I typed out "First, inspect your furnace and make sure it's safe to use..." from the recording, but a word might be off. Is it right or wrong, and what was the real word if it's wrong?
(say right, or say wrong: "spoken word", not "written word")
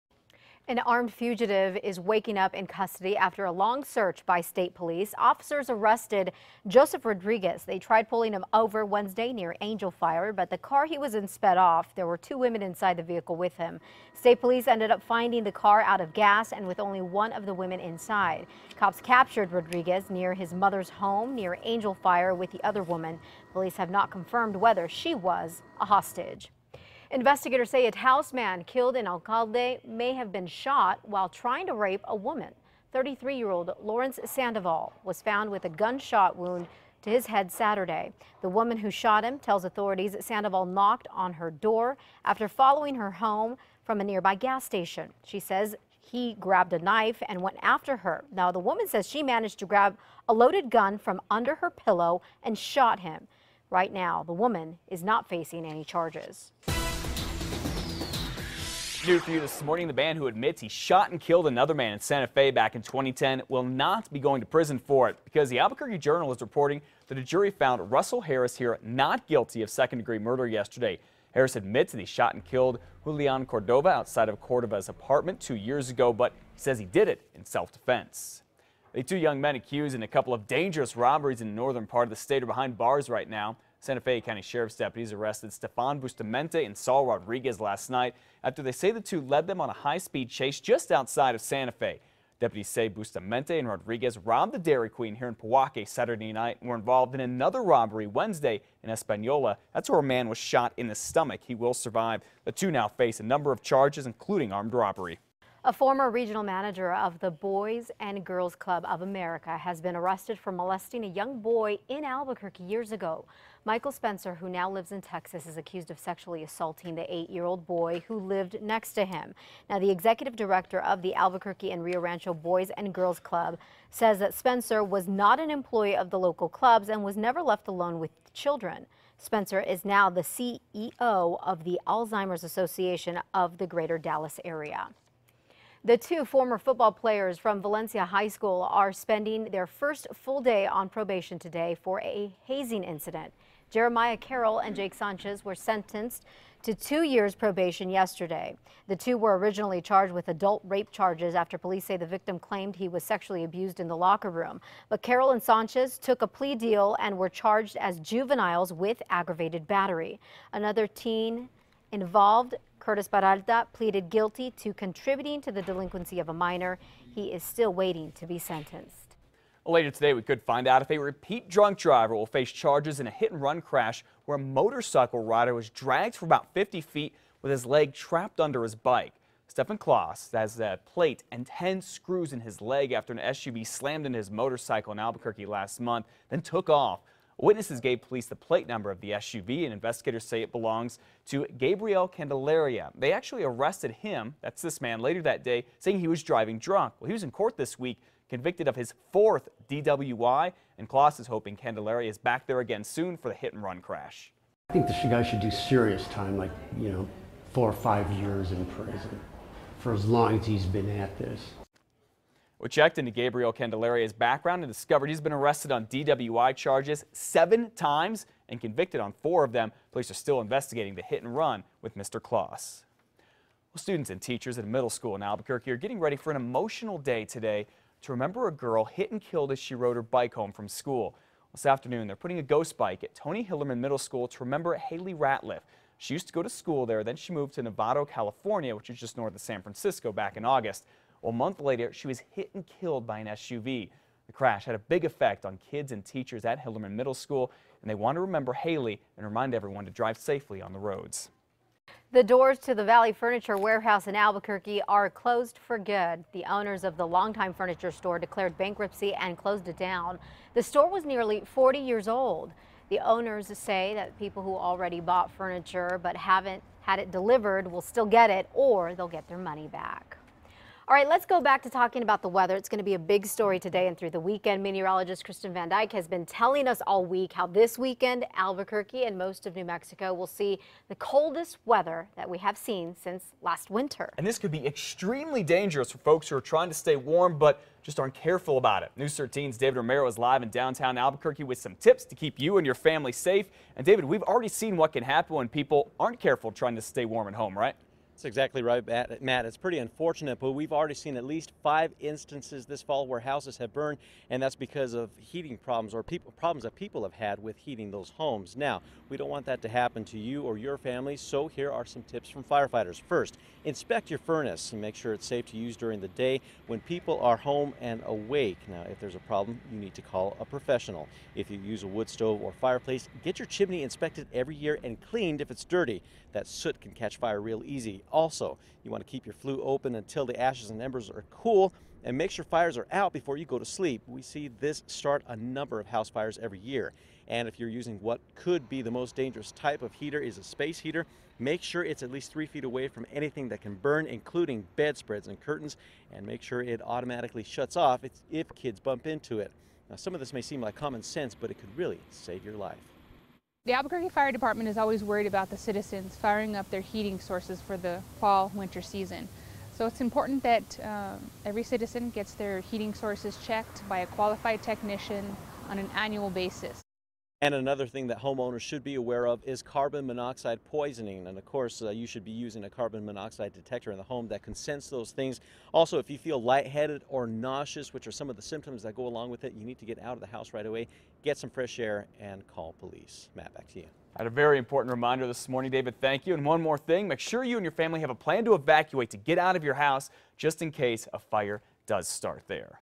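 right.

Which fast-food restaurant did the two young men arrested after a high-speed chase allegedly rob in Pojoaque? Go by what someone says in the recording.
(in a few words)
Dairy Queen.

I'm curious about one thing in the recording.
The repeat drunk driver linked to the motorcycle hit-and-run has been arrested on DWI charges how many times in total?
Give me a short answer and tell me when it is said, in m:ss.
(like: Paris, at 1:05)
7, at 3:37.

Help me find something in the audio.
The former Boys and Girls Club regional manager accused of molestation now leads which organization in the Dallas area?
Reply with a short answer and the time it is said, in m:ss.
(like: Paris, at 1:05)
Alzheimer's Association, at 2:11.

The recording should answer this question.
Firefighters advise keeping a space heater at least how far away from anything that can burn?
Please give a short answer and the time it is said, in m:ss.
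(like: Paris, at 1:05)
3 feet, at 5:42.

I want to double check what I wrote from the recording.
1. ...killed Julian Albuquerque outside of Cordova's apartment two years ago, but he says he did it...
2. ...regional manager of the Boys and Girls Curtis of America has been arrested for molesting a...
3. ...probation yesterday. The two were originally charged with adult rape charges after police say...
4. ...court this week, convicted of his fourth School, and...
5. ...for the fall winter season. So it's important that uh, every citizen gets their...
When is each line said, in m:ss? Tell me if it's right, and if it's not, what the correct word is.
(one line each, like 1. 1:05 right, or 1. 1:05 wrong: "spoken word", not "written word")
1. 1:12 wrong: "Cordova", not "Albuquerque"
2. 1:46 wrong: "Club", not "Curtis"
3. 2:27 right
4. 3:17 wrong: "DWI", not "School"
5. 5:57 right.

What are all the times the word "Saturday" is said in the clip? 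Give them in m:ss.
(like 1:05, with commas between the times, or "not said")
0:37, 1:35.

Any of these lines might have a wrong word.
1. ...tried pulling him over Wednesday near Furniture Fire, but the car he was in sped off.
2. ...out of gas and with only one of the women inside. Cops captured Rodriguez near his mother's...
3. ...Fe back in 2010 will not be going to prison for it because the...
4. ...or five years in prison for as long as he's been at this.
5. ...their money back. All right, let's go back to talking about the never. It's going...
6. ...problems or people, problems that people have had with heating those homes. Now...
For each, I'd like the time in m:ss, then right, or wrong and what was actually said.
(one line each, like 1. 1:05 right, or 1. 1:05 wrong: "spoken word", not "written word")
1. 0:07 wrong: "Angel", not "Furniture"
2. 0:15 right
3. 1:02 right
4. 3:27 right
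5. 4:29 wrong: "weather", not "never"
6. 5:05 right.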